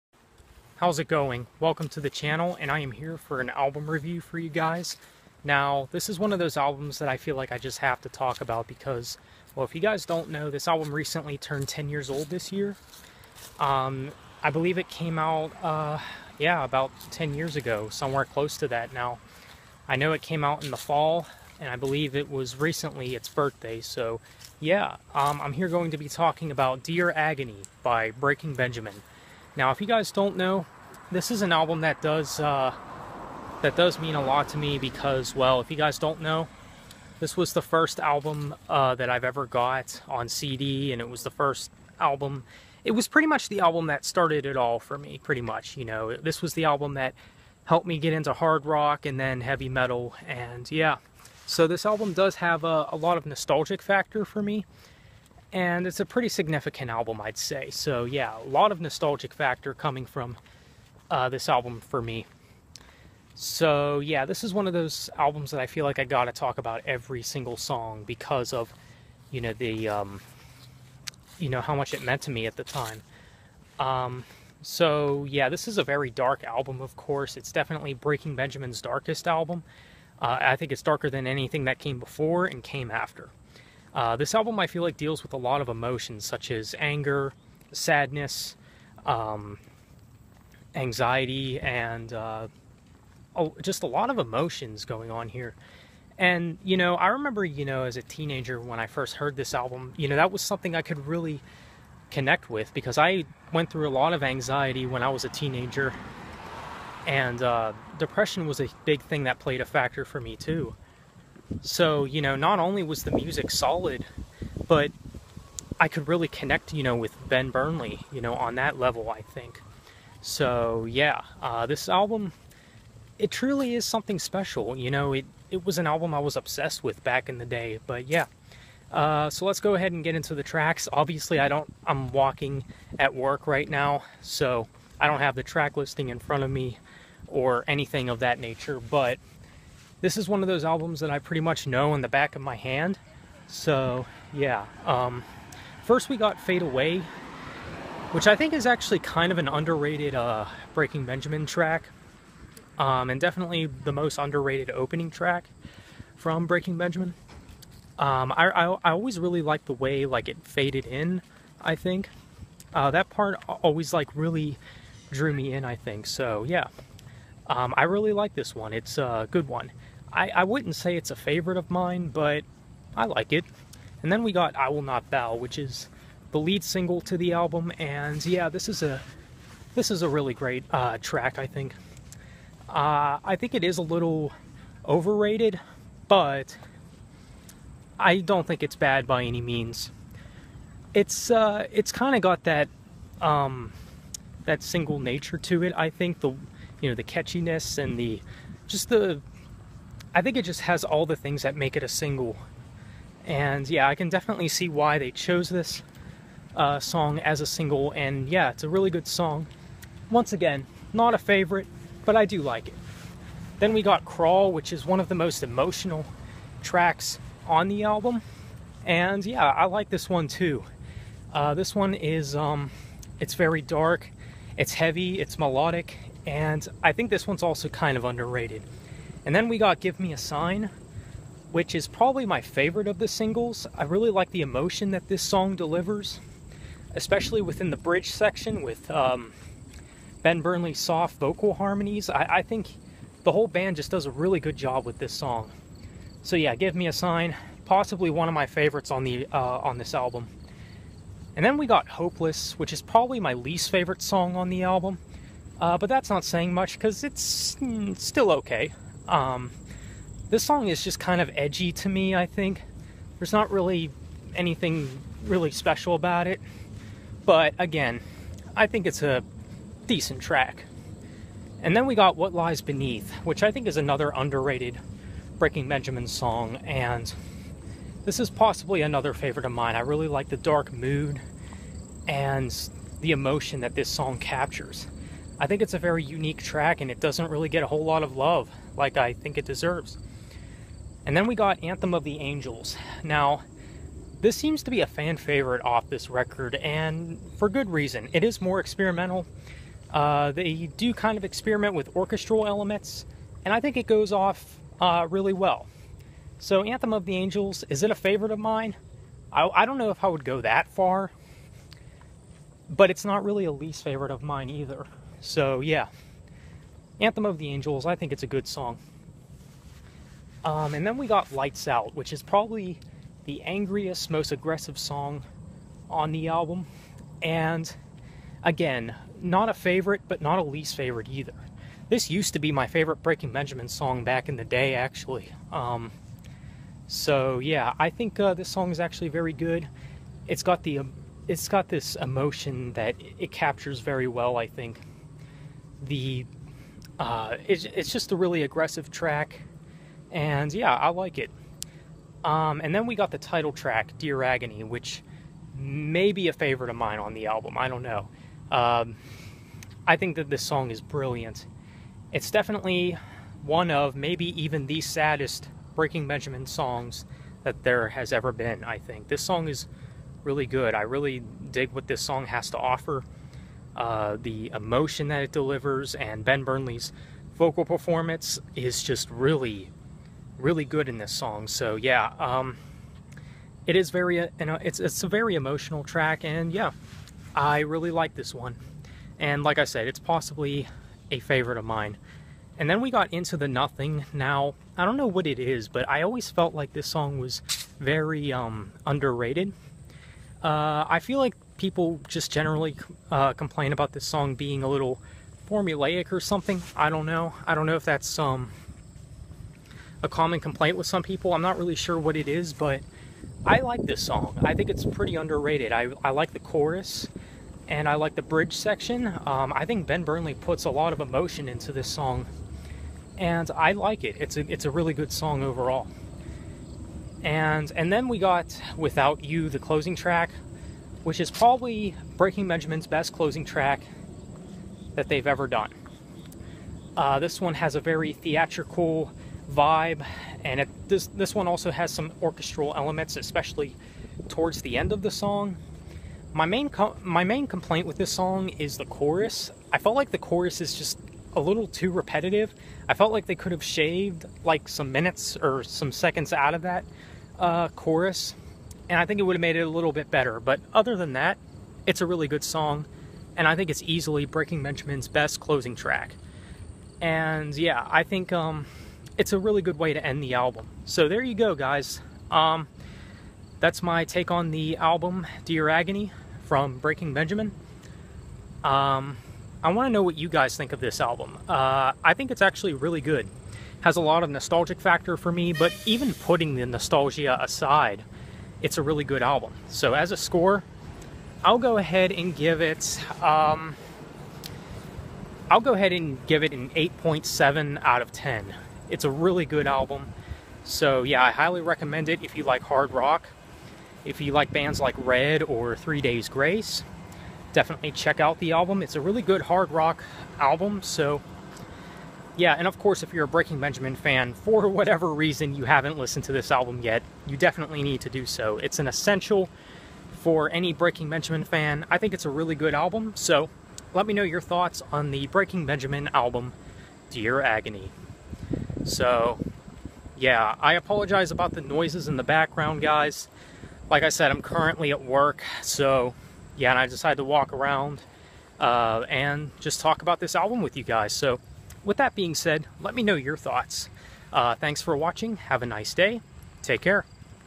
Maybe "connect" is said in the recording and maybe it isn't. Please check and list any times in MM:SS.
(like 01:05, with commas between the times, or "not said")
01:42, 01:56.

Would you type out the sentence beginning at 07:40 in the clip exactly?
But other than that, it's a really good song, and I think it's easily Breaking Benjamin's best closing track.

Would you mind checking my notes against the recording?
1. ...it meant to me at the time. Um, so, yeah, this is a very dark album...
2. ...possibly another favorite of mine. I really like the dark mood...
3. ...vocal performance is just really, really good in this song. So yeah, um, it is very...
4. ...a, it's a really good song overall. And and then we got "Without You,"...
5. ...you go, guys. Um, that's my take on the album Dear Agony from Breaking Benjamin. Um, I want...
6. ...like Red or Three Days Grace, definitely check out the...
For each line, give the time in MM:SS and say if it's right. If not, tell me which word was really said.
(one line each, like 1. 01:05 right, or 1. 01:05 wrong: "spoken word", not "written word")
1. 01:11 right
2. 04:38 right
3. 06:17 right
4. 07:04 right
5. 07:51 right
6. 08:24 right.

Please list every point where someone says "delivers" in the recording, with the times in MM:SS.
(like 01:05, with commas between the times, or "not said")
03:55, 06:15.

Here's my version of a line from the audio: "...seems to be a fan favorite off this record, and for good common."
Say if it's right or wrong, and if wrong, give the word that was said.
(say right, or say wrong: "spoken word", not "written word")
wrong: "reason", not "common".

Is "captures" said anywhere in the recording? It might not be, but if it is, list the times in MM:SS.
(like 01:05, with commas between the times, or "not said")
04:44, 05:43.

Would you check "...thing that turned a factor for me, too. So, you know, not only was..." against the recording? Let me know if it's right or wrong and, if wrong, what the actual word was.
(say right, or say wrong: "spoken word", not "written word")
wrong: "played", not "turned".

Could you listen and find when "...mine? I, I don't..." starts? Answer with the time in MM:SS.
05:08.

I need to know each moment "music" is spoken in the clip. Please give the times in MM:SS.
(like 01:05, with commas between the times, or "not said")
01:53.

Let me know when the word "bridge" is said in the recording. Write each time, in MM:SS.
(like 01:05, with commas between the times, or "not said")
03:57, 06:58.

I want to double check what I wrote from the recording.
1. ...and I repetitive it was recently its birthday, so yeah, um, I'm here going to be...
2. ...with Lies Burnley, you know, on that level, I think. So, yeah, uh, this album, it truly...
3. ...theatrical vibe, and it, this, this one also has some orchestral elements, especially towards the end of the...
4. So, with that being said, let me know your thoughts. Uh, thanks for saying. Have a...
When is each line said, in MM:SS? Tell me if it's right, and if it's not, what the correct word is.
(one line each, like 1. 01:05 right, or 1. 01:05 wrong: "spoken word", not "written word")
1. 00:21 wrong: "believe", not "repetitive"
2. 01:56 wrong: "Ben", not "Lies"
3. 07:18 right
4. 09:01 wrong: "watching", not "saying".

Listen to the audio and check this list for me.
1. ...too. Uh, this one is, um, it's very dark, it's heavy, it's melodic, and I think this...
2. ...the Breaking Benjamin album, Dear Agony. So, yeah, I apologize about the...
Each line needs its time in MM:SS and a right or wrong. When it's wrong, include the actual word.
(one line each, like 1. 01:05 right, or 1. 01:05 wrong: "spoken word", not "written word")
1. 03:40 right
2. 08:45 right.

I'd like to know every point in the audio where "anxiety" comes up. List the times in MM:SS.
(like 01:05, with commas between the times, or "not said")
01:30, 01:44.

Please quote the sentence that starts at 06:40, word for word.
Uh, I feel like people just generally uh, complain about this song being a little formulaic or something.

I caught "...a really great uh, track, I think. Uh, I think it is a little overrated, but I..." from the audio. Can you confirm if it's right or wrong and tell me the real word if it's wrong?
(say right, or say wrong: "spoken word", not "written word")
right.